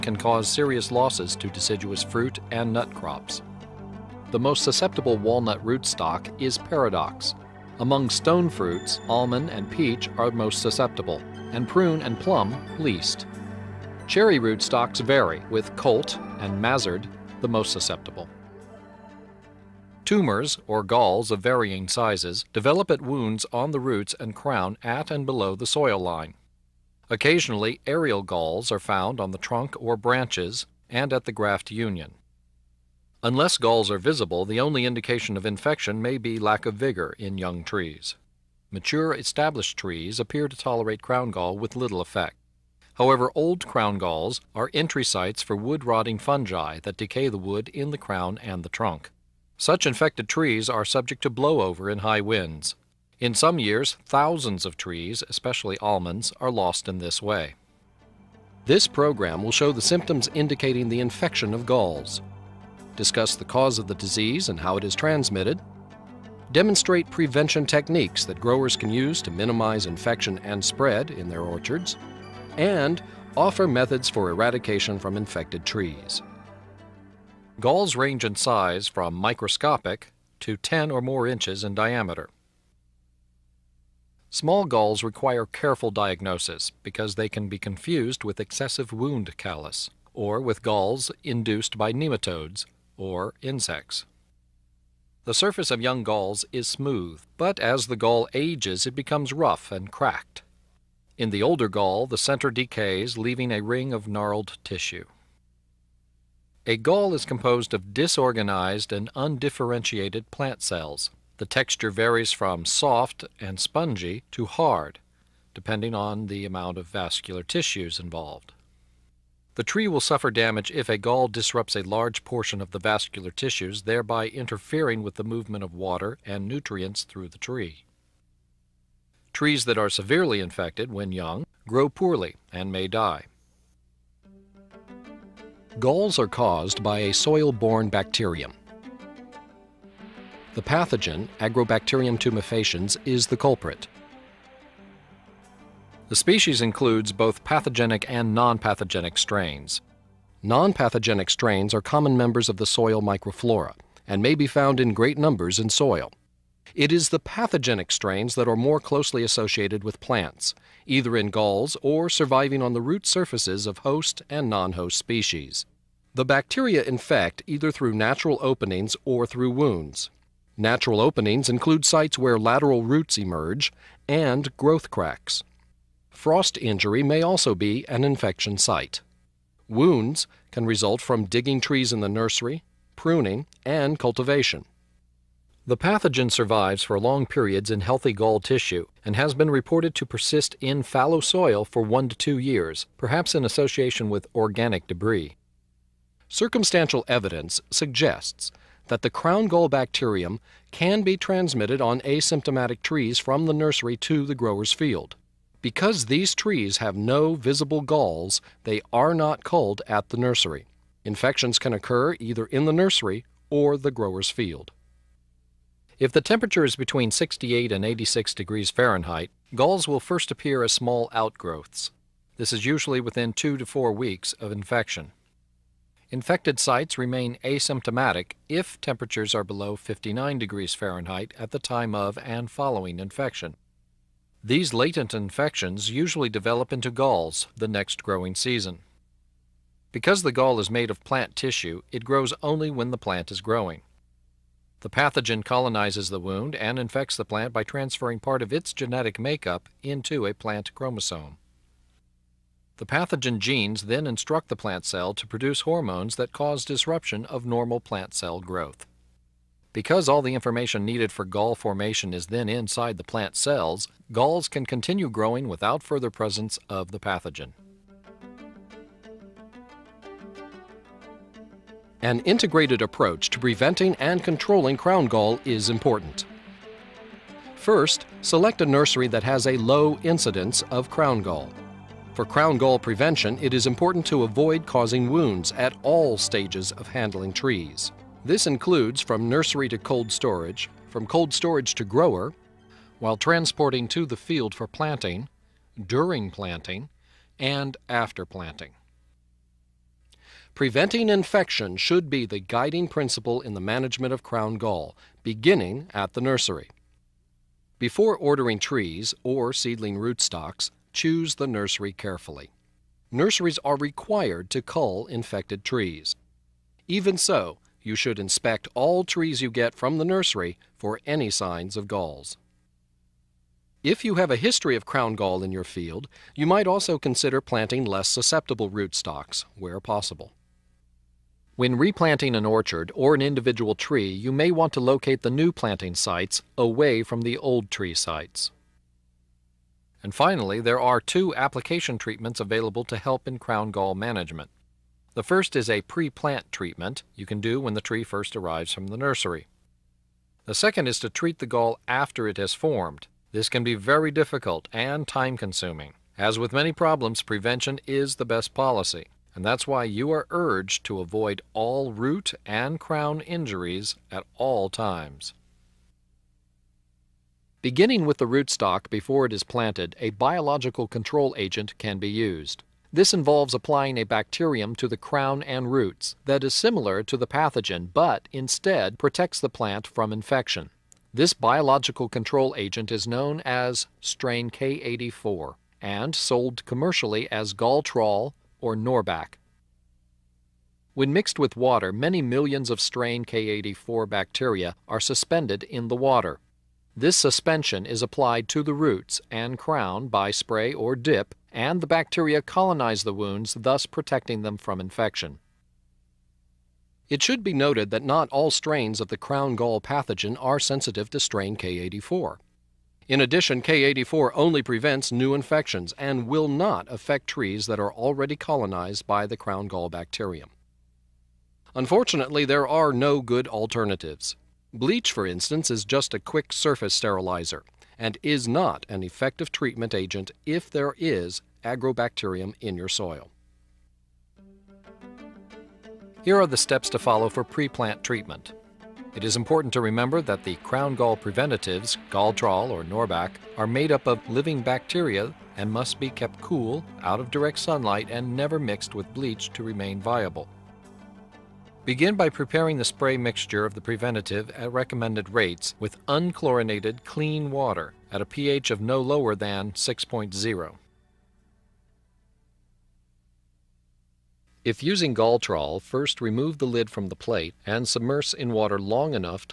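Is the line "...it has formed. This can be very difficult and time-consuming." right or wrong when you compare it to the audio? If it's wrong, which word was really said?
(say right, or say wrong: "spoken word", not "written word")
right.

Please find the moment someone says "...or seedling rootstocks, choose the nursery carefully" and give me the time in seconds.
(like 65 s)
309 s.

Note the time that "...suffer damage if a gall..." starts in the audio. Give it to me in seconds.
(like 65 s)
120 s.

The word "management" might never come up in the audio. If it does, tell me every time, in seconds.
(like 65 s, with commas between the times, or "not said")
303 s, 343 s.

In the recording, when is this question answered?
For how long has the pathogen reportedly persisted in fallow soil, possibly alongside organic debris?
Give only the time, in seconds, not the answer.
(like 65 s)
191 s.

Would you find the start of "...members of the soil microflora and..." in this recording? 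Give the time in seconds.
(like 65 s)
152 s.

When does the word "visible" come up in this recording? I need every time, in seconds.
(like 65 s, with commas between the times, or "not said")
33 s, 207 s.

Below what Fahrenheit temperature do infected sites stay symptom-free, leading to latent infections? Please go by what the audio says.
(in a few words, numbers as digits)
59 degrees Fahrenheit.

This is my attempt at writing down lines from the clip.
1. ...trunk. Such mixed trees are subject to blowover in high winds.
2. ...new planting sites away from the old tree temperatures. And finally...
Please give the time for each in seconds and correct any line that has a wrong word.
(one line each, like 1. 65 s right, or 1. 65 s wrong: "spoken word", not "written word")
1. 48 s wrong: "infected", not "mixed"
2. 335 s wrong: "sites", not "temperatures".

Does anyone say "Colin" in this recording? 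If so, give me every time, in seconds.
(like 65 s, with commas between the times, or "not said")
not said.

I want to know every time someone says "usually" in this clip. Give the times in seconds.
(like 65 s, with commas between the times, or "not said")
222 s, 235 s.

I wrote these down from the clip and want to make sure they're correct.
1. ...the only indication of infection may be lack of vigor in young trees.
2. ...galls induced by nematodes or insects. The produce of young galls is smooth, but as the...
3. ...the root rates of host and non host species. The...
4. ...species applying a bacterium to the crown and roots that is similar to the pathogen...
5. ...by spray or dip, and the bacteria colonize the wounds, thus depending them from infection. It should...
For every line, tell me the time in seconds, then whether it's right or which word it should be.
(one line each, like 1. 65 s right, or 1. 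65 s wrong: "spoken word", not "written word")
1. 34 s right
2. 90 s wrong: "surface", not "produce"
3. 162 s wrong: "surfaces", not "rates"
4. 373 s wrong: "involves", not "species"
5. 400 s wrong: "protecting", not "depending".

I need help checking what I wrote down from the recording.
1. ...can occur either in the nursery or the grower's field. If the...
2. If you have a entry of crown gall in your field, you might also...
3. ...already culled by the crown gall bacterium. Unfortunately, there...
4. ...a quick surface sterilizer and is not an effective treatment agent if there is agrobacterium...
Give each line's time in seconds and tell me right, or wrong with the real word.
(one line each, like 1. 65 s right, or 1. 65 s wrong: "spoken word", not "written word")
1. 211 s right
2. 323 s wrong: "history", not "entry"
3. 417 s wrong: "colonized", not "culled"
4. 426 s right.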